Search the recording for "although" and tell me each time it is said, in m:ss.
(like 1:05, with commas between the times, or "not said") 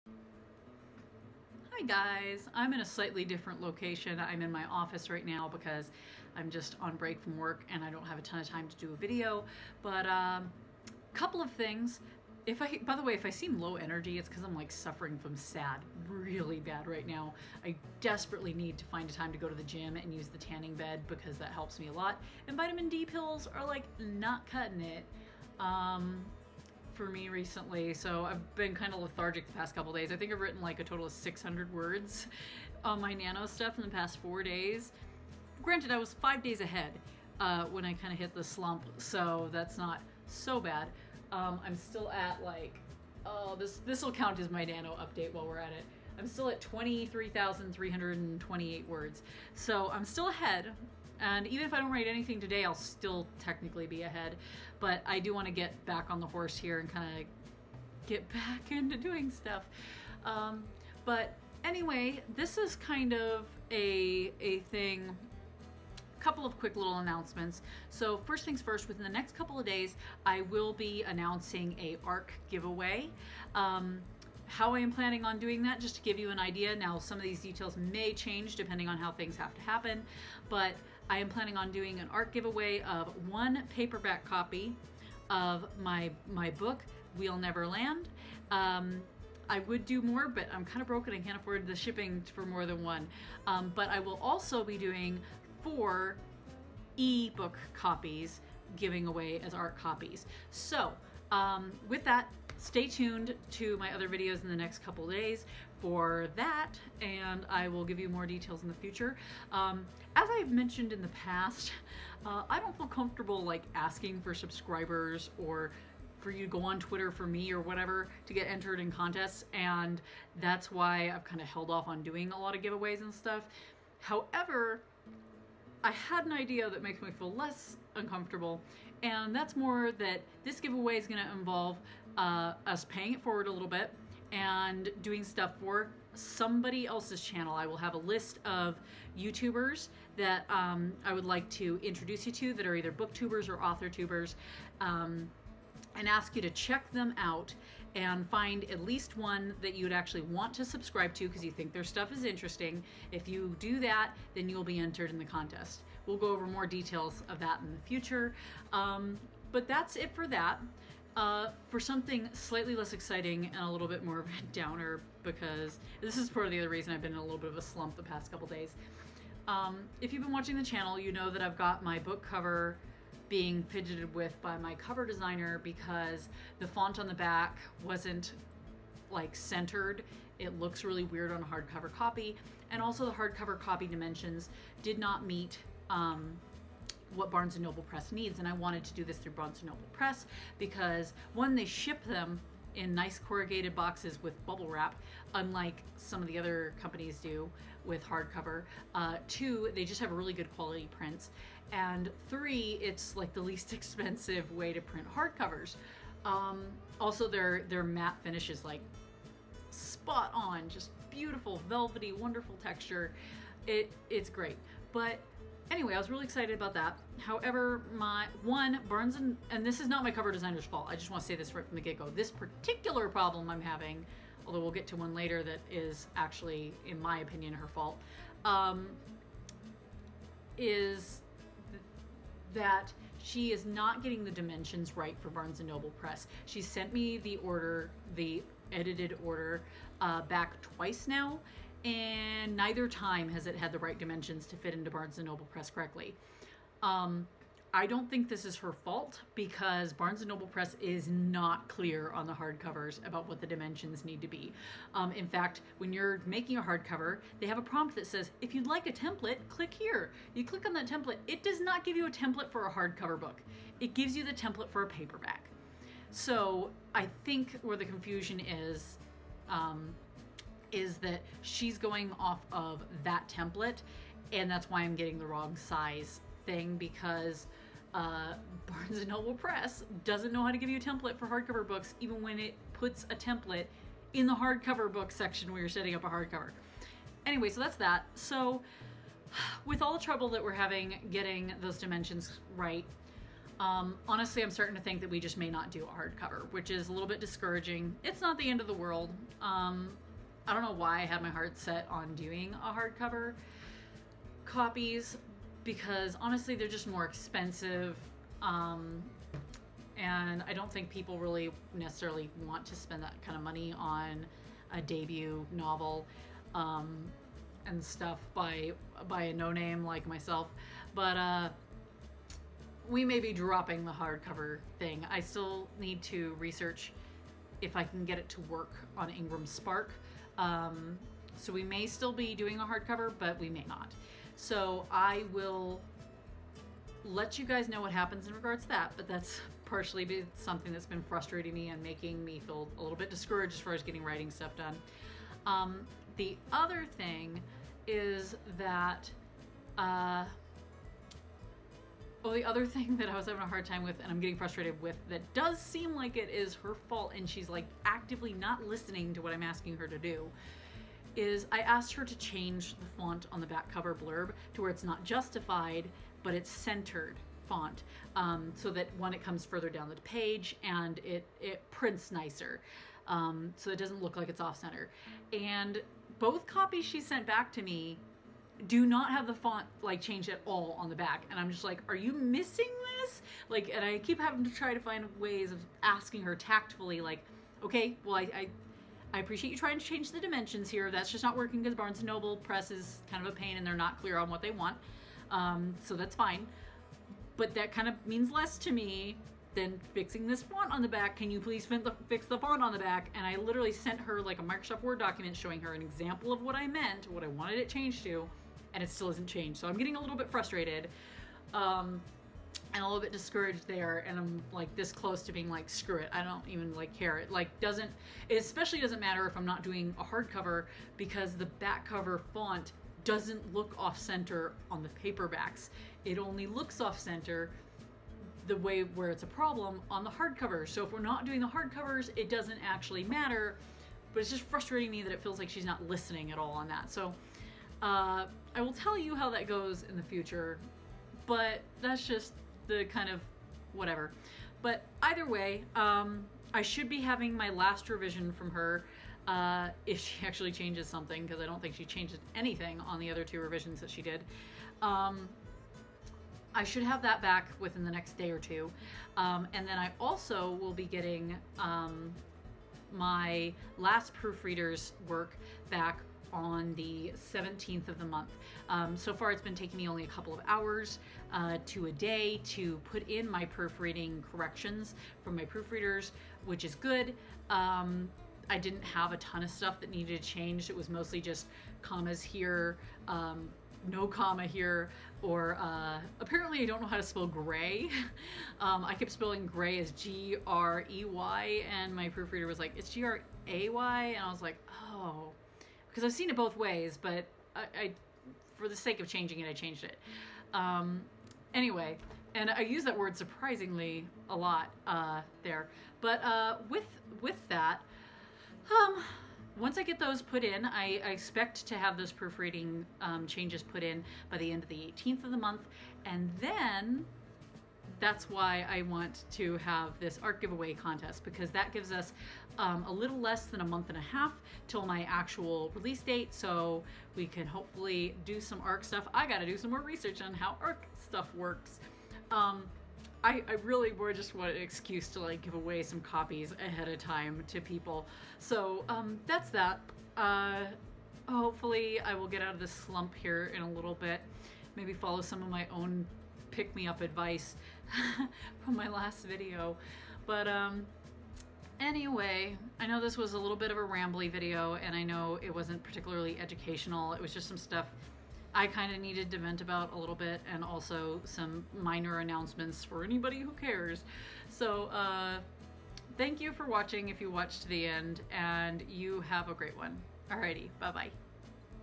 3:44.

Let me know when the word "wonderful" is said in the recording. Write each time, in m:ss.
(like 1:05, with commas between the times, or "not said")
3:32.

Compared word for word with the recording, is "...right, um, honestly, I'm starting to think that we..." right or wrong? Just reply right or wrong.
right.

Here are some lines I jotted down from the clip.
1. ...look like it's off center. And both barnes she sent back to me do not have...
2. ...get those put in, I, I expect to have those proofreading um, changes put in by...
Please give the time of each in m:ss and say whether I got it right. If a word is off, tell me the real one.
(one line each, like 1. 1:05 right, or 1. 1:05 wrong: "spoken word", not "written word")
1. 6:14 wrong: "copies", not "barnes"
2. 8:29 right.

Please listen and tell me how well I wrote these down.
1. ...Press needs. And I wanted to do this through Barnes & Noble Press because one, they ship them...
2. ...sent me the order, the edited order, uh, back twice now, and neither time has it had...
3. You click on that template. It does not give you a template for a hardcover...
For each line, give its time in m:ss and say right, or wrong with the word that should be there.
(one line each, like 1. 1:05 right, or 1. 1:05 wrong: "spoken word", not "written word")
1. 3:07 right
2. 3:56 right
3. 4:20 right.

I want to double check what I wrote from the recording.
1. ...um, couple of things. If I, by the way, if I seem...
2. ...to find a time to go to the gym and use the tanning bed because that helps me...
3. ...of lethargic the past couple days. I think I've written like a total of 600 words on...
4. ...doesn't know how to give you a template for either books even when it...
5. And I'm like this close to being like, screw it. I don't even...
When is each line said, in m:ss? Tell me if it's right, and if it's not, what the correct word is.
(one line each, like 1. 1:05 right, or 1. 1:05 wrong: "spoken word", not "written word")
1. 0:10 right
2. 0:18 right
3. 0:28 right
4. 4:40 wrong: "hardcover", not "either"
5. 6:54 right.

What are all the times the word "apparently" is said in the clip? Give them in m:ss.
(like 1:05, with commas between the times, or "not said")
8:06.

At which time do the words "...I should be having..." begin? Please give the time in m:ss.
7:26.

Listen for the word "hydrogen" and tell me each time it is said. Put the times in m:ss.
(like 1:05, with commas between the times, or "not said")
not said.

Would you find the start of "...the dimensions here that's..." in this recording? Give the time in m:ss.
6:30.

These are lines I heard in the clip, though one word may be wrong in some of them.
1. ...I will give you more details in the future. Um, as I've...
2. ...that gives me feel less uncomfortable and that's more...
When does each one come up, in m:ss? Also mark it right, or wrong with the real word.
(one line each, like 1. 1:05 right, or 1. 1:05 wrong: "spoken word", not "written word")
1. 1:47 right
2. 2:06 wrong: "makes", not "gives".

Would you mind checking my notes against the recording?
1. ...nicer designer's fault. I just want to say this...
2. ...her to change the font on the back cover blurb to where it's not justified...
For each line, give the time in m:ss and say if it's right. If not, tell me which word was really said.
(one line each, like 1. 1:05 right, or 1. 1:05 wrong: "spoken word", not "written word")
1. 3:40 wrong: "cover", not "nicer"
2. 6:01 right.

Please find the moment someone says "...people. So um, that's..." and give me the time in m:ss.
8:57.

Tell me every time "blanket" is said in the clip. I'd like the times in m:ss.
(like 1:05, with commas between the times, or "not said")
not said.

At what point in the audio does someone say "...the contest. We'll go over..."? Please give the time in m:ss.
2:35.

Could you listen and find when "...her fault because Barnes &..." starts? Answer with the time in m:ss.
4:08.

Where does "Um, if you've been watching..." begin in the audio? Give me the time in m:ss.
2:49.